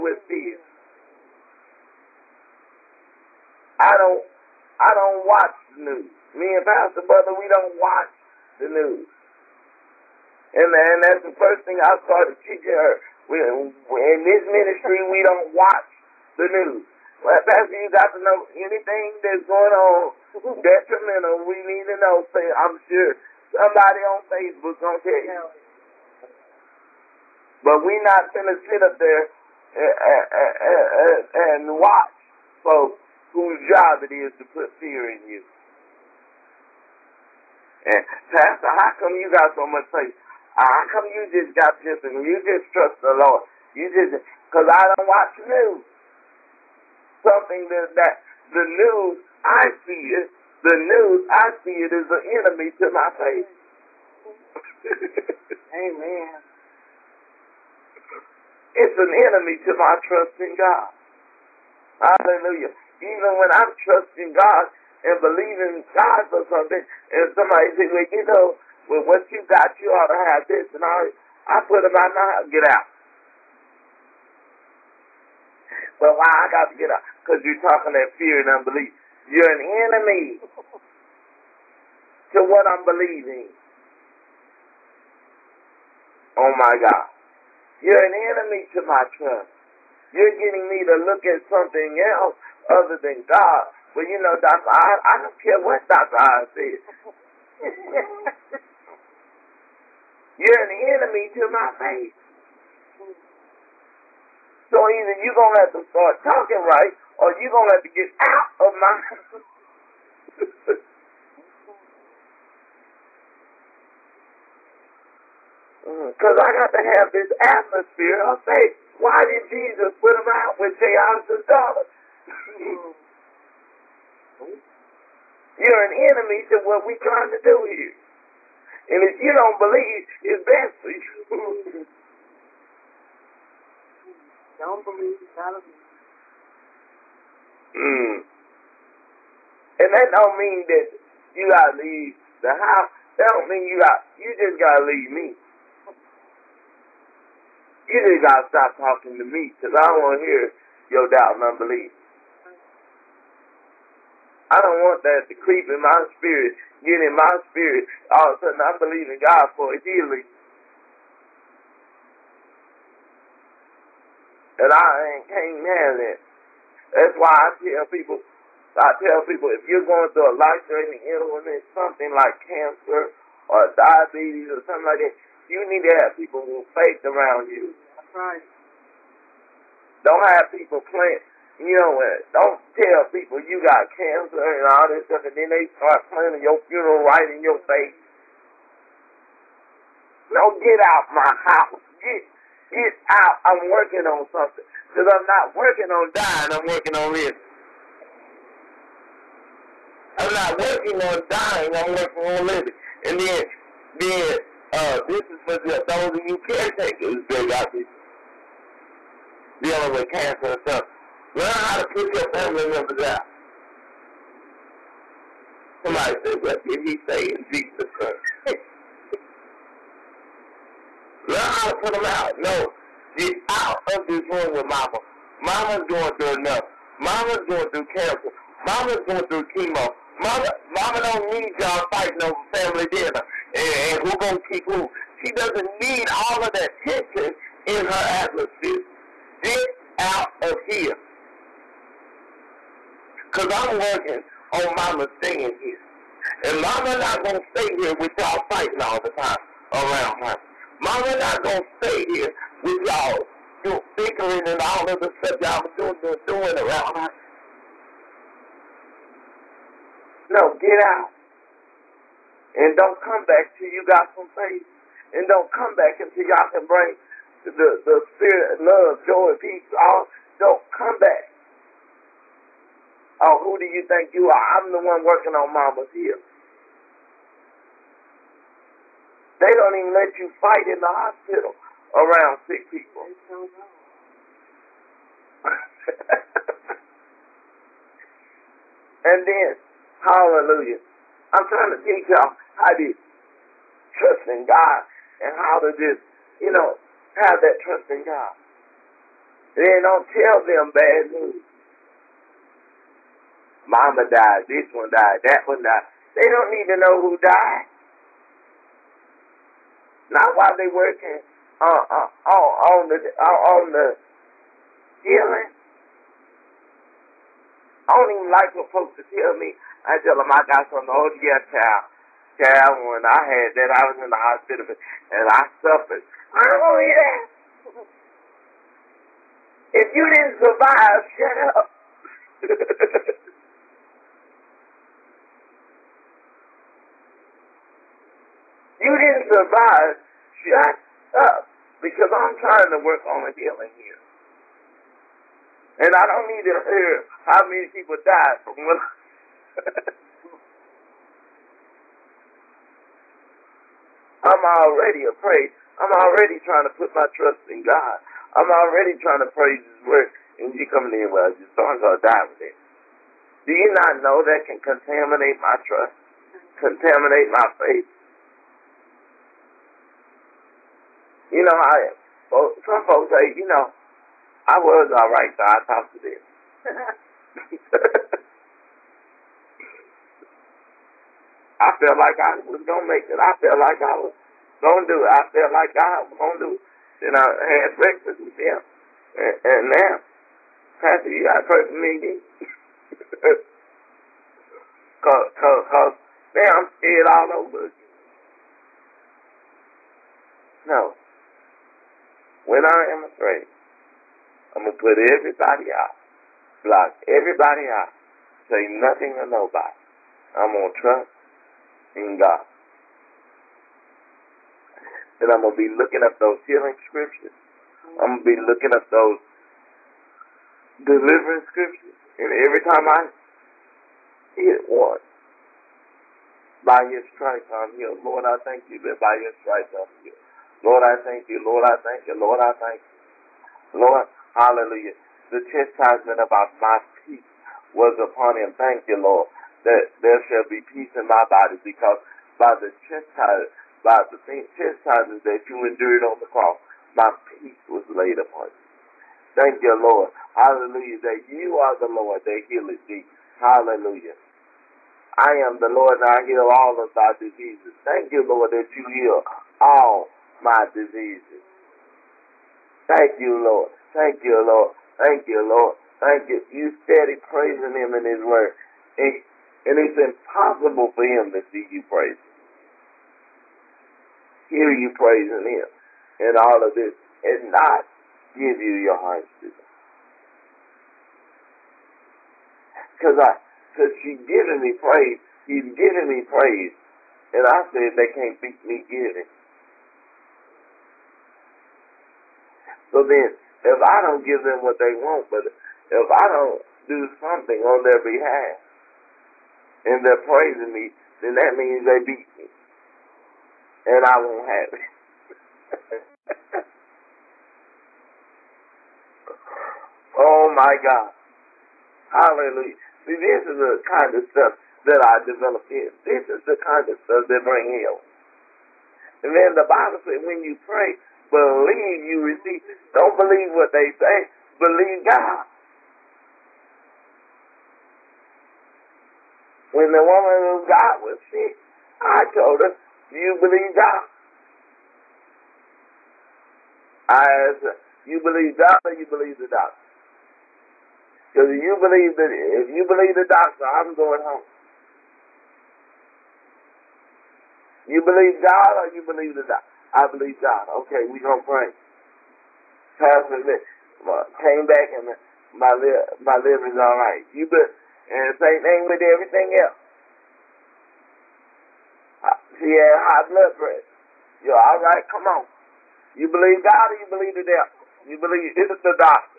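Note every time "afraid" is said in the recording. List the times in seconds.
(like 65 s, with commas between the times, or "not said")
355 s, 403 s.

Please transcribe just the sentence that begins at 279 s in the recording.
They don't even let you fight in the hospital around sick people.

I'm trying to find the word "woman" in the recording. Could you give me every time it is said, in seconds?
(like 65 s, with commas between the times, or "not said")
530 s.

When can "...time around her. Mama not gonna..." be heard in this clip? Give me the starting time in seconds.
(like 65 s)
249 s.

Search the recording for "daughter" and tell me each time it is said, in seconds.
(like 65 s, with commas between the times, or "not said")
121 s.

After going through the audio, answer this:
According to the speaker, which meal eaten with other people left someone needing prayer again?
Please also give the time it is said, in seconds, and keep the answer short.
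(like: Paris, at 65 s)
Breakfast, at 387 s.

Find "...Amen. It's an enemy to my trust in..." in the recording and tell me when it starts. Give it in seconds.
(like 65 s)
55 s.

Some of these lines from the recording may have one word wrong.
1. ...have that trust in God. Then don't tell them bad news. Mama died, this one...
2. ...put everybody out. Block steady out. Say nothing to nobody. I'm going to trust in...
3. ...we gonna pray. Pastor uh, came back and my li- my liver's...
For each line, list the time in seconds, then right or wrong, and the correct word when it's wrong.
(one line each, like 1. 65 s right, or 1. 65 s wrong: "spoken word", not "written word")
1. 297 s right
2. 404 s wrong: "everybody", not "steady"
3. 551 s right.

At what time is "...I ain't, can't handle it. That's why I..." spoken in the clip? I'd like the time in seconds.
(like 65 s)
164 s.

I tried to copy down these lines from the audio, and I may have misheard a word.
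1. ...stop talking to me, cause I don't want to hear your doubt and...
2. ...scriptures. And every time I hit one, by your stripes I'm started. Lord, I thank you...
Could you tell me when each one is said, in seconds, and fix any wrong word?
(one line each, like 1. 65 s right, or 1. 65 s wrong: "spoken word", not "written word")
1. 148 s right
2. 421 s wrong: "healed", not "started".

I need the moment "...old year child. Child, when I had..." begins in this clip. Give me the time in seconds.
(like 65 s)
320 s.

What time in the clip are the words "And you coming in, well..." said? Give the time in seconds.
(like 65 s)
360 s.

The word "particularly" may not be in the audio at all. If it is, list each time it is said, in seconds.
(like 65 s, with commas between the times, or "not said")
not said.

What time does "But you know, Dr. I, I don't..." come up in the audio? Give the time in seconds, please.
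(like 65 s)
93 s.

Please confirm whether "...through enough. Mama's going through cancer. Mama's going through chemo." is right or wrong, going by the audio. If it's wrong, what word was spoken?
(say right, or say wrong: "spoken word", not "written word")
right.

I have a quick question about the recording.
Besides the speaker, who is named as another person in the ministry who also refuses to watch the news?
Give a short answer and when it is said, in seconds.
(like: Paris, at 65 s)
Pastor Butler, at 6 s.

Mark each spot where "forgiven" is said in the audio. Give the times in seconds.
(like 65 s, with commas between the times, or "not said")
not said.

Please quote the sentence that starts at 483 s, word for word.
Cause I, cause she's giving me praise.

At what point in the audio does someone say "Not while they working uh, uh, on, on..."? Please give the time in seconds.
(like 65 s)
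310 s.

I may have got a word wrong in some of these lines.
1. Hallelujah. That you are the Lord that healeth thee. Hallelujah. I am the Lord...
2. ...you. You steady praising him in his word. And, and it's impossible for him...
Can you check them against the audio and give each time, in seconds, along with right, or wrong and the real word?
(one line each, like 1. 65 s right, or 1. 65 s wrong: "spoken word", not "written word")
1. 450 s right
2. 466 s right.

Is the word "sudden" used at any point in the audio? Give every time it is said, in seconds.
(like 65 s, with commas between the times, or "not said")
158 s.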